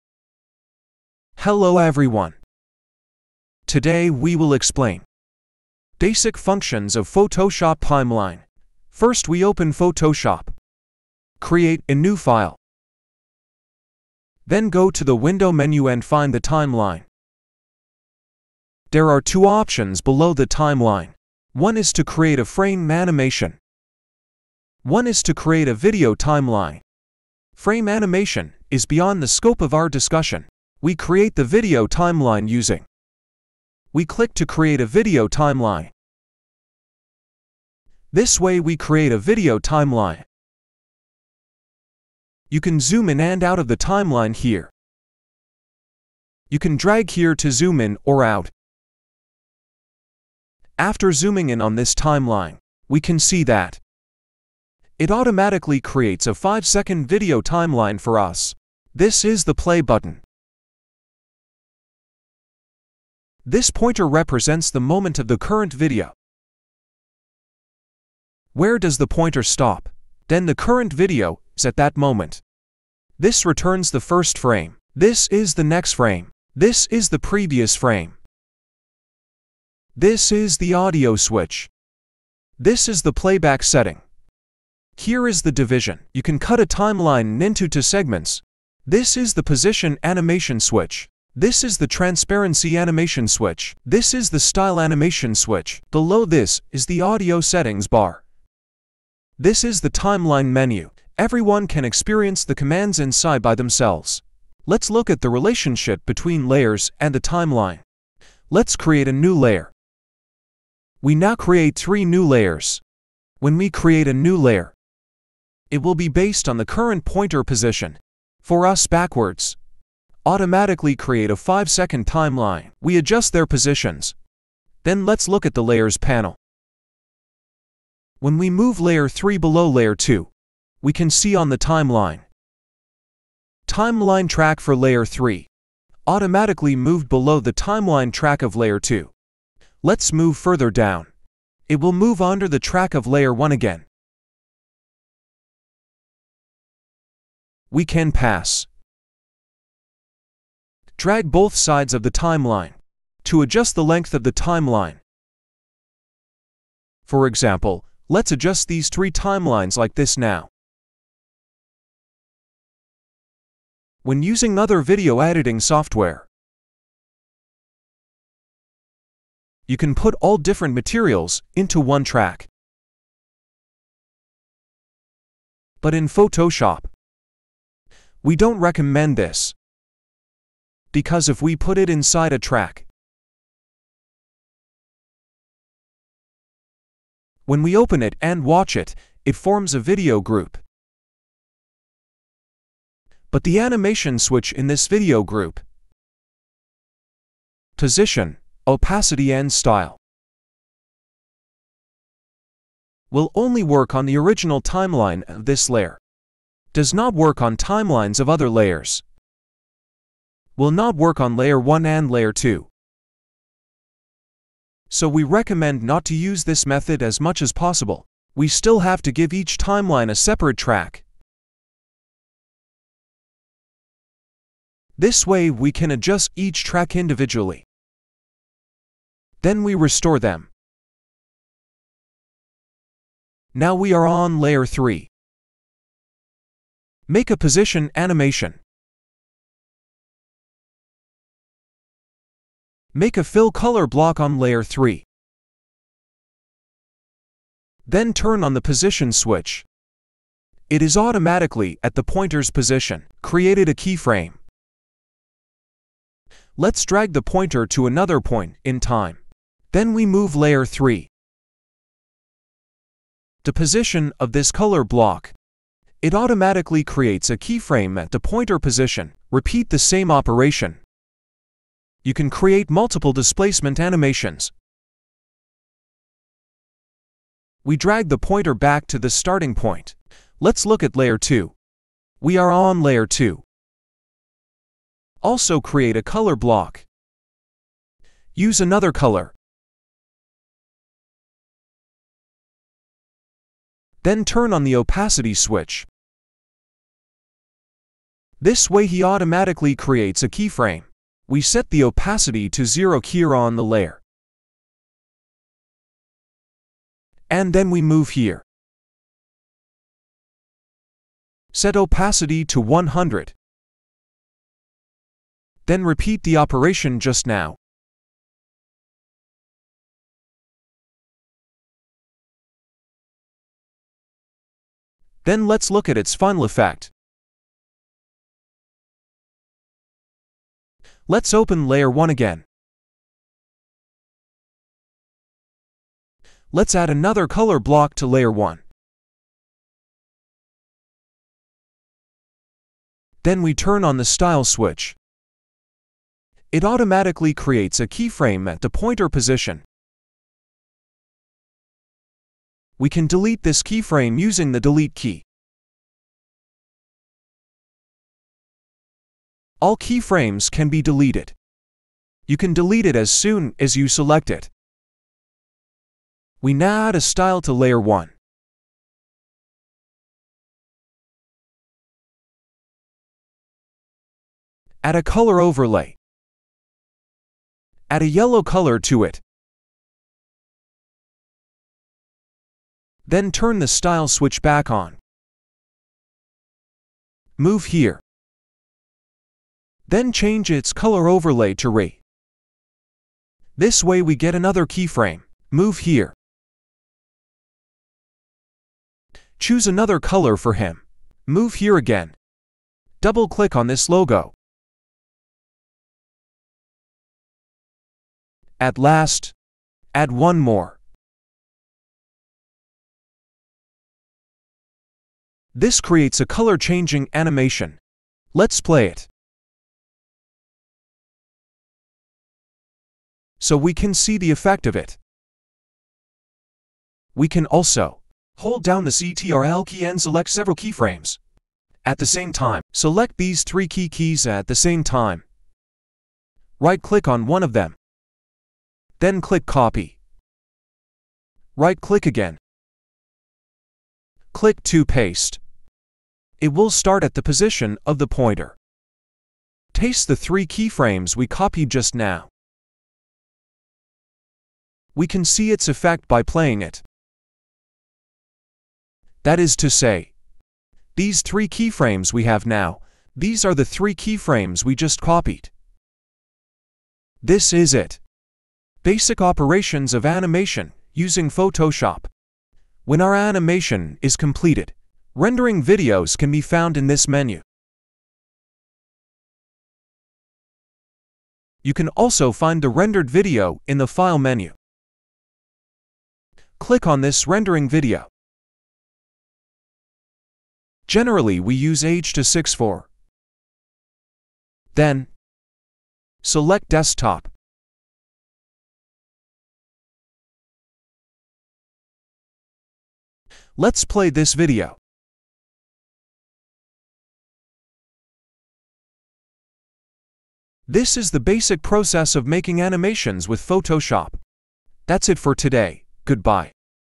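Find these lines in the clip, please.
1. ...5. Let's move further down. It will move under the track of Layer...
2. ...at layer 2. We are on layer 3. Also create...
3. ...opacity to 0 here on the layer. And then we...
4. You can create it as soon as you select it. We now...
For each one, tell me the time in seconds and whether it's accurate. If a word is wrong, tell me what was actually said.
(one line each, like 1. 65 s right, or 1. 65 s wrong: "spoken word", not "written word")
1. 138 s wrong: "2", not "5"
2. 280 s wrong: "2", not "3"
3. 301 s right
4. 362 s wrong: "delete", not "create".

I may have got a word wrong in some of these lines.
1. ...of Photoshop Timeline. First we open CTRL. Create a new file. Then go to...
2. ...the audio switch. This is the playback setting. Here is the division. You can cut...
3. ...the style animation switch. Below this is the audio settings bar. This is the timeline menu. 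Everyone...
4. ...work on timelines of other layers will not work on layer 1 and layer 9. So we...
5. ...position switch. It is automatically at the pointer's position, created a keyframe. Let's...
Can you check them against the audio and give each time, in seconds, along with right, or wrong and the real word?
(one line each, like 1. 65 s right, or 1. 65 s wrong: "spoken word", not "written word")
1. 6 s wrong: "Photoshop", not "CTRL"
2. 80 s right
3. 94 s right
4. 207 s wrong: "2", not "9"
5. 248 s right.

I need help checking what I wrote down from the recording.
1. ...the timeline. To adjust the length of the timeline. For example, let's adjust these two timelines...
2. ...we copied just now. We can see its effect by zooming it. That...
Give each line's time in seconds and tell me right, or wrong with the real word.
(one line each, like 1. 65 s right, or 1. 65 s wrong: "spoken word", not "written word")
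1. 152 s wrong: "three", not "two"
2. 451 s wrong: "playing", not "zooming".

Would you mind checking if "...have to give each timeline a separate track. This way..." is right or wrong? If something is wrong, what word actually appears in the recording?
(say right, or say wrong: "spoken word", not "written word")
right.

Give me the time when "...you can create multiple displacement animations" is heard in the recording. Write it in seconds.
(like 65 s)
272 s.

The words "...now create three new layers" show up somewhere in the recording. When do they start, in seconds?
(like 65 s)
111 s.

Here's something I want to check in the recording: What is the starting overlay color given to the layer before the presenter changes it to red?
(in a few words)
Yellow.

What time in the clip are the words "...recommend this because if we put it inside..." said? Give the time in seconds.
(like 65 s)
178 s.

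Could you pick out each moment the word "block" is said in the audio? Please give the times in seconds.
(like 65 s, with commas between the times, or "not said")
243 s, 264 s, 286 s, 337 s.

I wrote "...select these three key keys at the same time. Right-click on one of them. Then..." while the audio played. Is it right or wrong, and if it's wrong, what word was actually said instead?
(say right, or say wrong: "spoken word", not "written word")
right.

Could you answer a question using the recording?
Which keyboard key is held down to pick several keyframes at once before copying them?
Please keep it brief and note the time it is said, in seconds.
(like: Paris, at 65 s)
Ctrl, at 428 s.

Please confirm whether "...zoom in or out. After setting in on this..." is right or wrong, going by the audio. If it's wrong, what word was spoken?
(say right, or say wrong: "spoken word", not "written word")
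wrong: "zooming", not "setting".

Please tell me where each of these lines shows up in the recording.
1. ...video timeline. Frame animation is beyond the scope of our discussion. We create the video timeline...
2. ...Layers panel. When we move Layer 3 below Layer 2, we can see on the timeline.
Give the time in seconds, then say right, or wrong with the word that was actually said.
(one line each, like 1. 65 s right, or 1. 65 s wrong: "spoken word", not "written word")
1. 25 s right
2. 125 s right.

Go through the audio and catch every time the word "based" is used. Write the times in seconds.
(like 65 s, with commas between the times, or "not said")
116 s.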